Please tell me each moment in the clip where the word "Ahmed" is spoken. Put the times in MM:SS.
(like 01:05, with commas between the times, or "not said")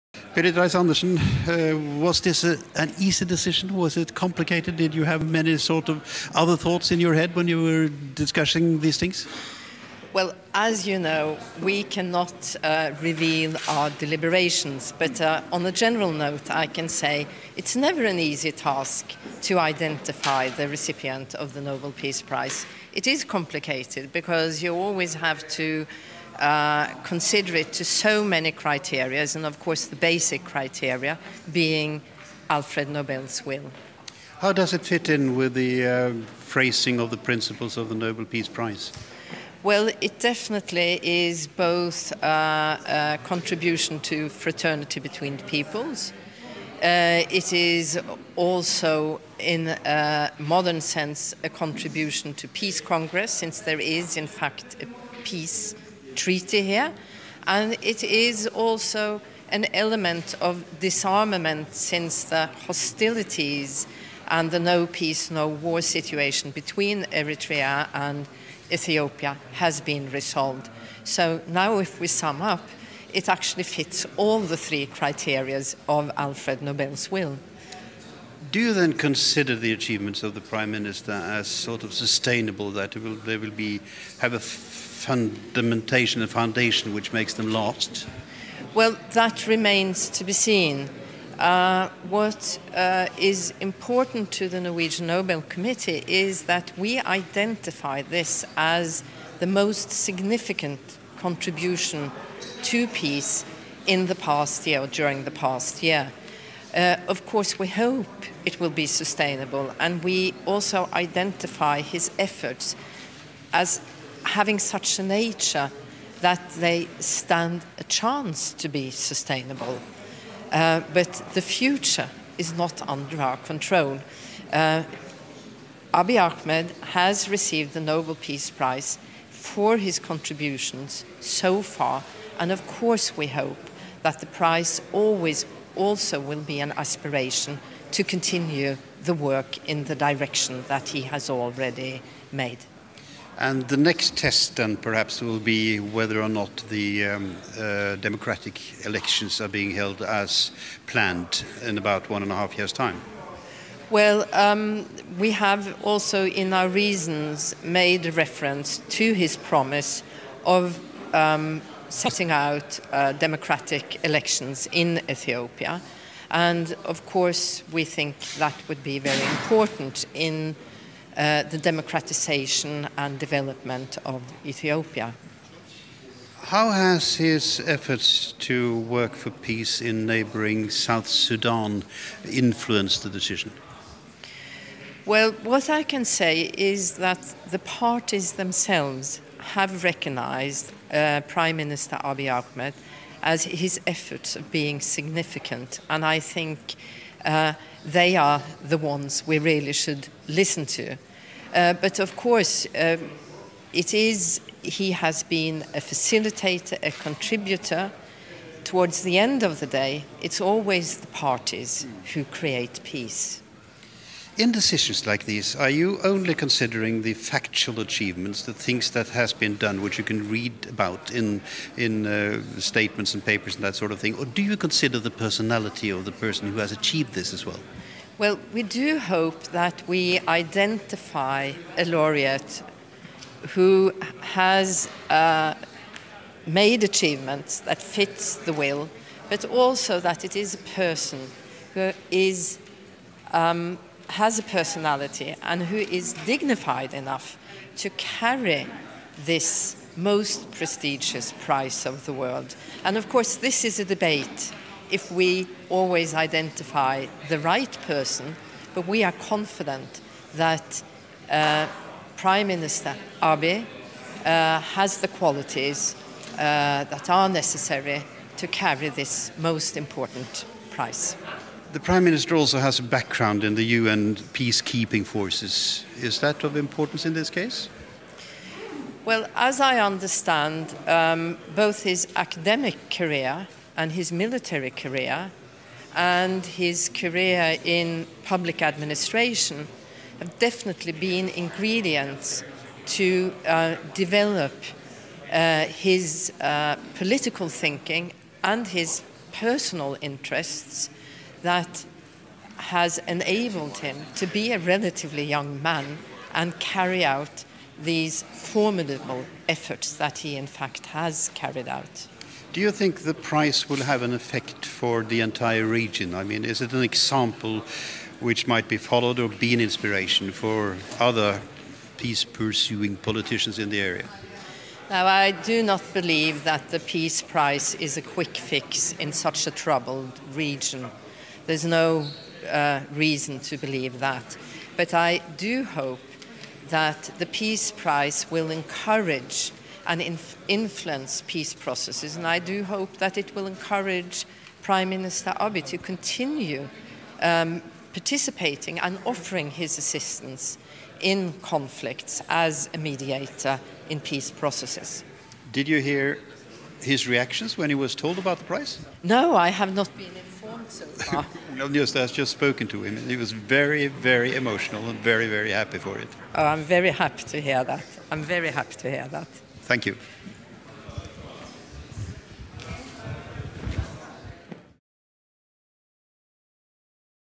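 02:06, 03:12.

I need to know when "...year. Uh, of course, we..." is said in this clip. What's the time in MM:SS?
01:45.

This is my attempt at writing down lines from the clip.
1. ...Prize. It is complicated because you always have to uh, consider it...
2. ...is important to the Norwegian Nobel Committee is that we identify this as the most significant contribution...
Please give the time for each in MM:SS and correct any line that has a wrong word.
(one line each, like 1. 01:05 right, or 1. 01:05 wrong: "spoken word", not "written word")
1. 00:22 right
2. 01:33 right.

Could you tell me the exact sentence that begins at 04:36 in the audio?
Is that of importance in this case?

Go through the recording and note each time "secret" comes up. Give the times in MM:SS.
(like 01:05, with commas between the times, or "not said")
not said.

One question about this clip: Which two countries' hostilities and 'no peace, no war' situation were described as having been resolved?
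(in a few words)
Eritrea and Ethiopia.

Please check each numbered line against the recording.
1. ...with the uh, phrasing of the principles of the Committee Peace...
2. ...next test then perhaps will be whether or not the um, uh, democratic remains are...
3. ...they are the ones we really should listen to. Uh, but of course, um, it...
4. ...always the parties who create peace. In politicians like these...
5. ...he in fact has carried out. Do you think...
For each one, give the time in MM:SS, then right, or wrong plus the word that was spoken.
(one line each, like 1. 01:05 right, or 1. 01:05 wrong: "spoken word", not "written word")
1. 00:35 wrong: "Nobel", not "Committee"
2. 02:23 wrong: "elections", not "remains"
3. 03:17 right
4. 03:30 wrong: "decisions", not "politicians"
5. 05:10 right.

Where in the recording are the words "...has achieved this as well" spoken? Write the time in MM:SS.
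03:46.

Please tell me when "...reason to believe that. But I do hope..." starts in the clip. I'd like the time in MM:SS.
05:32.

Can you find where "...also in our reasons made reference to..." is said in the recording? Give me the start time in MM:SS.
02:35.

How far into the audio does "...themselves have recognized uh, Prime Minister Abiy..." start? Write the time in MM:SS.
03:08.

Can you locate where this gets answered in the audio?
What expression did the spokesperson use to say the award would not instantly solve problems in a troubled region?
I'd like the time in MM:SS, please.
05:28.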